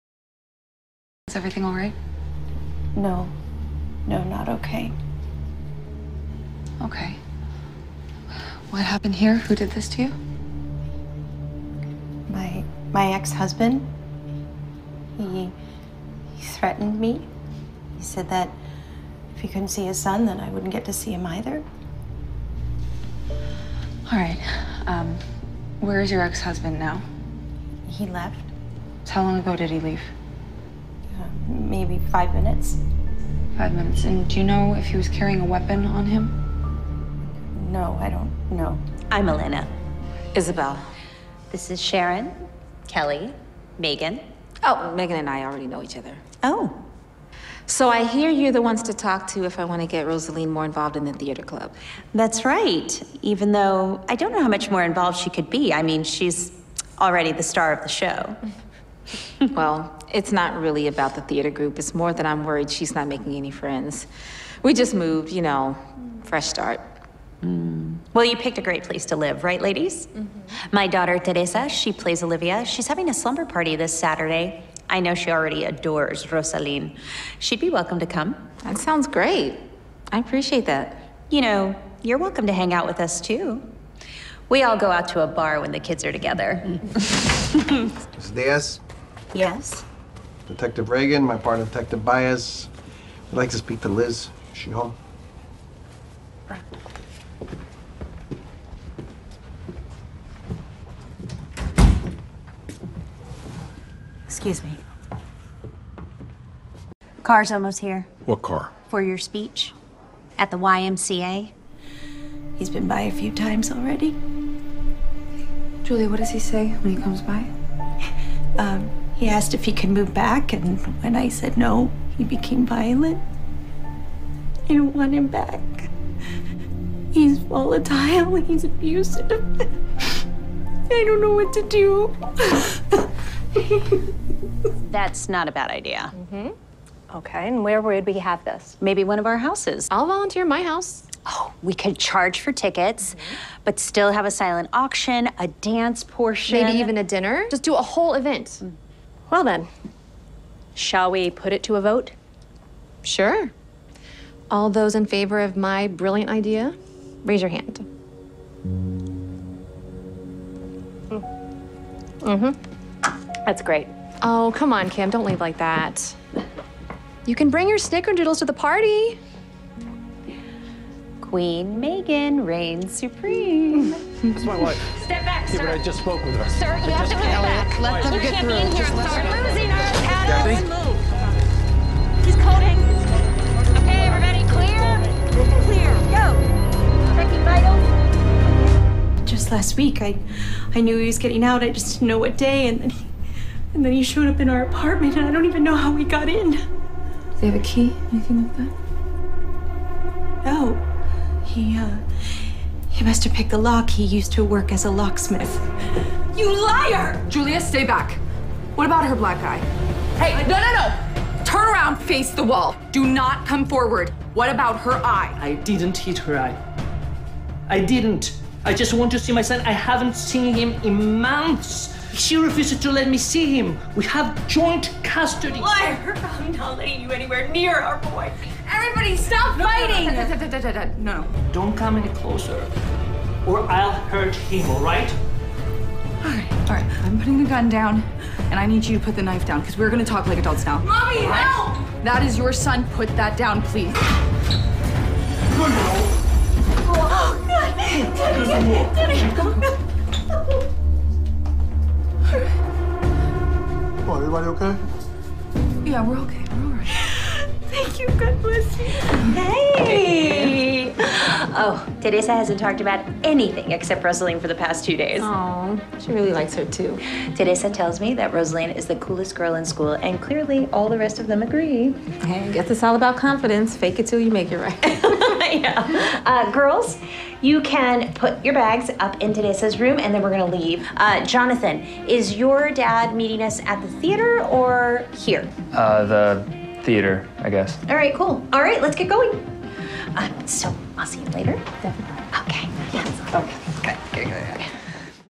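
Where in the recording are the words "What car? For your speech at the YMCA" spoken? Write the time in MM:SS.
01:48.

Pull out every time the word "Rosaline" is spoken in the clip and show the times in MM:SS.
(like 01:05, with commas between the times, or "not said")
00:50, 01:16, 04:24, 04:28.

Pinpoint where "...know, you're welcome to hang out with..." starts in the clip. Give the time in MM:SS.
01:21.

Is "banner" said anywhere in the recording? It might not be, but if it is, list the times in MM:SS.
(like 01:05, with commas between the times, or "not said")
not said.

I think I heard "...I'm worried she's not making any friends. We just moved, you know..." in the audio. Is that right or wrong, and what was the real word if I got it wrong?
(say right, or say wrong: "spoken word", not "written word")
right.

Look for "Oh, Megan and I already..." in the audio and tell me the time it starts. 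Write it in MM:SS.
00:44.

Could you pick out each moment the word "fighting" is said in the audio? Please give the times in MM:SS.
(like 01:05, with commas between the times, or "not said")
03:49.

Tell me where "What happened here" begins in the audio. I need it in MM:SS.
00:08.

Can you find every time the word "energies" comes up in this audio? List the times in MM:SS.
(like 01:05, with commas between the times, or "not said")
not said.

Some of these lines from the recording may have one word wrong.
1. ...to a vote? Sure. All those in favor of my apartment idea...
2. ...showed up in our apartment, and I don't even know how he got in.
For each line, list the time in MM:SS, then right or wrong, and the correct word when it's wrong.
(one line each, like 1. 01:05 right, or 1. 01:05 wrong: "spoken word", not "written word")
1. 02:31 wrong: "brilliant", not "apartment"
2. 03:14 right.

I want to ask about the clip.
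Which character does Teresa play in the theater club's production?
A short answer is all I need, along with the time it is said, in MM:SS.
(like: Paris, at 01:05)
Olivia, at 01:12.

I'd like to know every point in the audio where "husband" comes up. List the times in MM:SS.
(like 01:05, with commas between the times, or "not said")
00:13, 00:26.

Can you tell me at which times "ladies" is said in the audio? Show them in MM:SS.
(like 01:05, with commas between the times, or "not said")
01:09.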